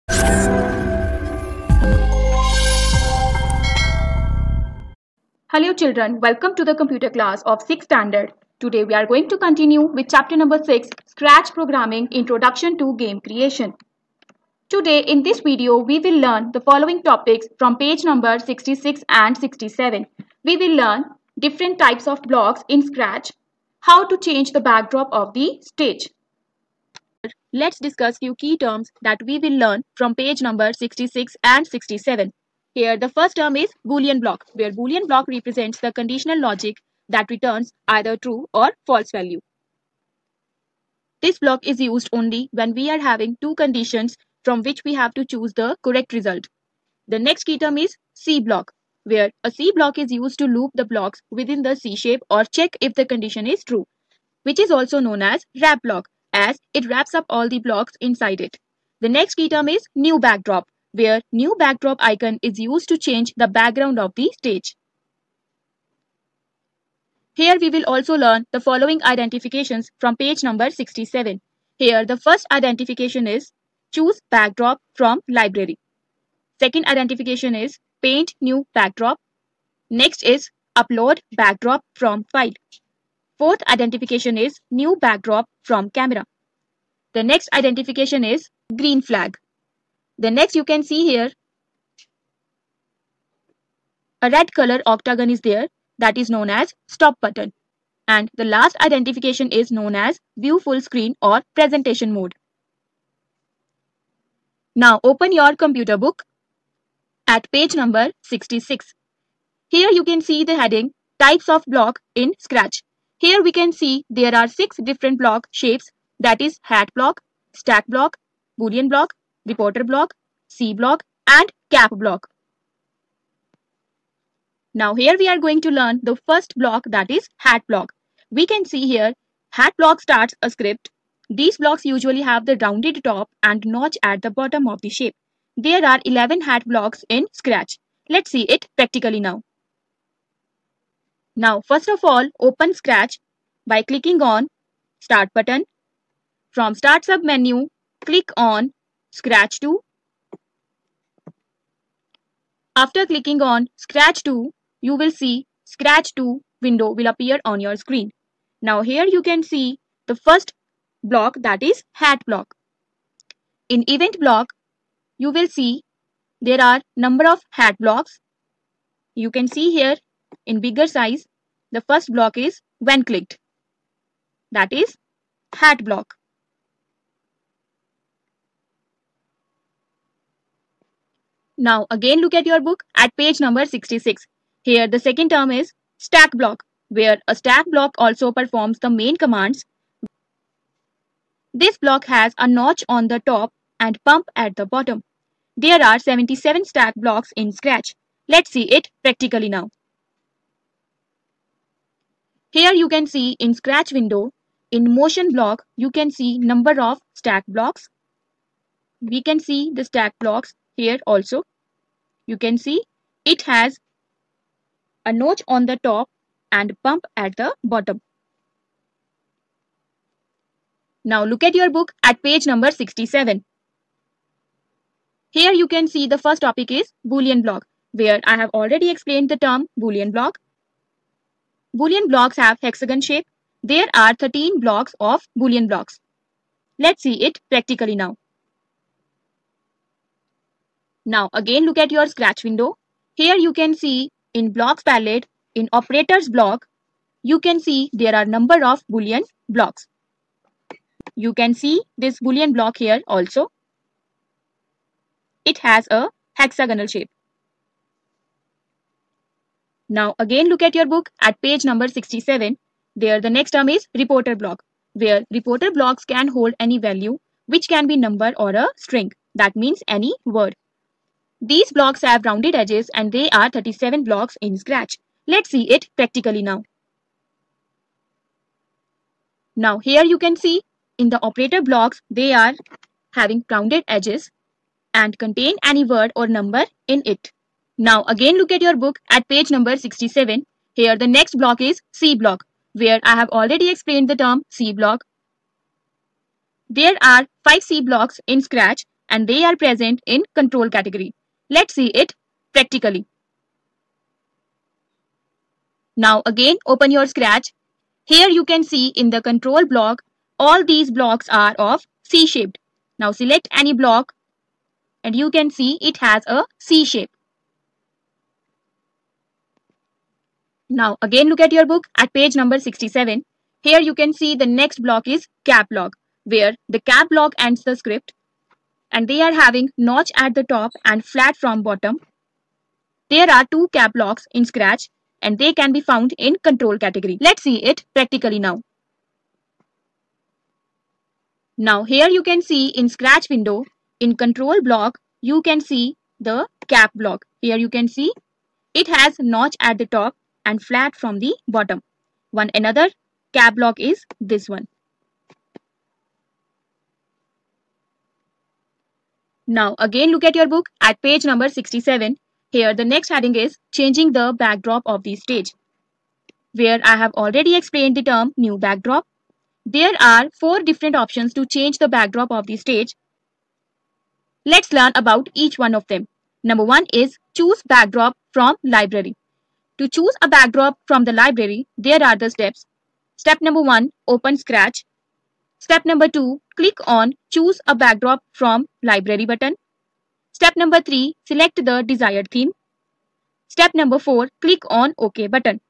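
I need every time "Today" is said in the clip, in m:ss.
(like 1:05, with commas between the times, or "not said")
0:08, 0:14.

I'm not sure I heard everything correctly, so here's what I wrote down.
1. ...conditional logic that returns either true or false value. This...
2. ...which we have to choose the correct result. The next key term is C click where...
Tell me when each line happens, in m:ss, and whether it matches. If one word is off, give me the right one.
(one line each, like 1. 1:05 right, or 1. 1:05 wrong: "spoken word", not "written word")
1. 0:35 right
2. 0:44 wrong: "block", not "click".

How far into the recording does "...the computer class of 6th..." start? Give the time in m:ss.
0:06.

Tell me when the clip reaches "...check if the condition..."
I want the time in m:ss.
0:52.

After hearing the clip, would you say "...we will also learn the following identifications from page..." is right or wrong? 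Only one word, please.
right.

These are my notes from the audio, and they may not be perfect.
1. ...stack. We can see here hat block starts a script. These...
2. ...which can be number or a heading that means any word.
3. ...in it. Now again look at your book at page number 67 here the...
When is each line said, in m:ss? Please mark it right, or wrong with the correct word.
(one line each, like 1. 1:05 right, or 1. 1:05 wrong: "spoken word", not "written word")
1. 2:07 wrong: "block", not "stack"
2. 4:27 wrong: "string", not "heading"
3. 4:46 right.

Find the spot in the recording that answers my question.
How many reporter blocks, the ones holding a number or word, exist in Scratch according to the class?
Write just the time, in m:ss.
4:33.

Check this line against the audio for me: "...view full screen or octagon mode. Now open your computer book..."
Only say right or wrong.
wrong.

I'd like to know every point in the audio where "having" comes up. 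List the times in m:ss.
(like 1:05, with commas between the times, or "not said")
0:42, 4:43, 5:29.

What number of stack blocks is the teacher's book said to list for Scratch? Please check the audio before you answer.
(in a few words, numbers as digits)
77.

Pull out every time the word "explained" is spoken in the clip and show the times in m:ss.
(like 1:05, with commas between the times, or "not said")
3:48, 4:53, 6:07.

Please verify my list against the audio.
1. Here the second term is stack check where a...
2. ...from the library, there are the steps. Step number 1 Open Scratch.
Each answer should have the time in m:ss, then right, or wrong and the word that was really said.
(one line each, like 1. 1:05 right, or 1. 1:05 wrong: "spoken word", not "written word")
1. 3:04 wrong: "block", not "check"
2. 6:20 right.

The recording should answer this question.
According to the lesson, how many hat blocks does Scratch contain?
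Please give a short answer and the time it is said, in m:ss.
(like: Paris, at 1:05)
11, at 2:16.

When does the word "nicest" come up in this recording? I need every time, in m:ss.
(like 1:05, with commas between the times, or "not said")
not said.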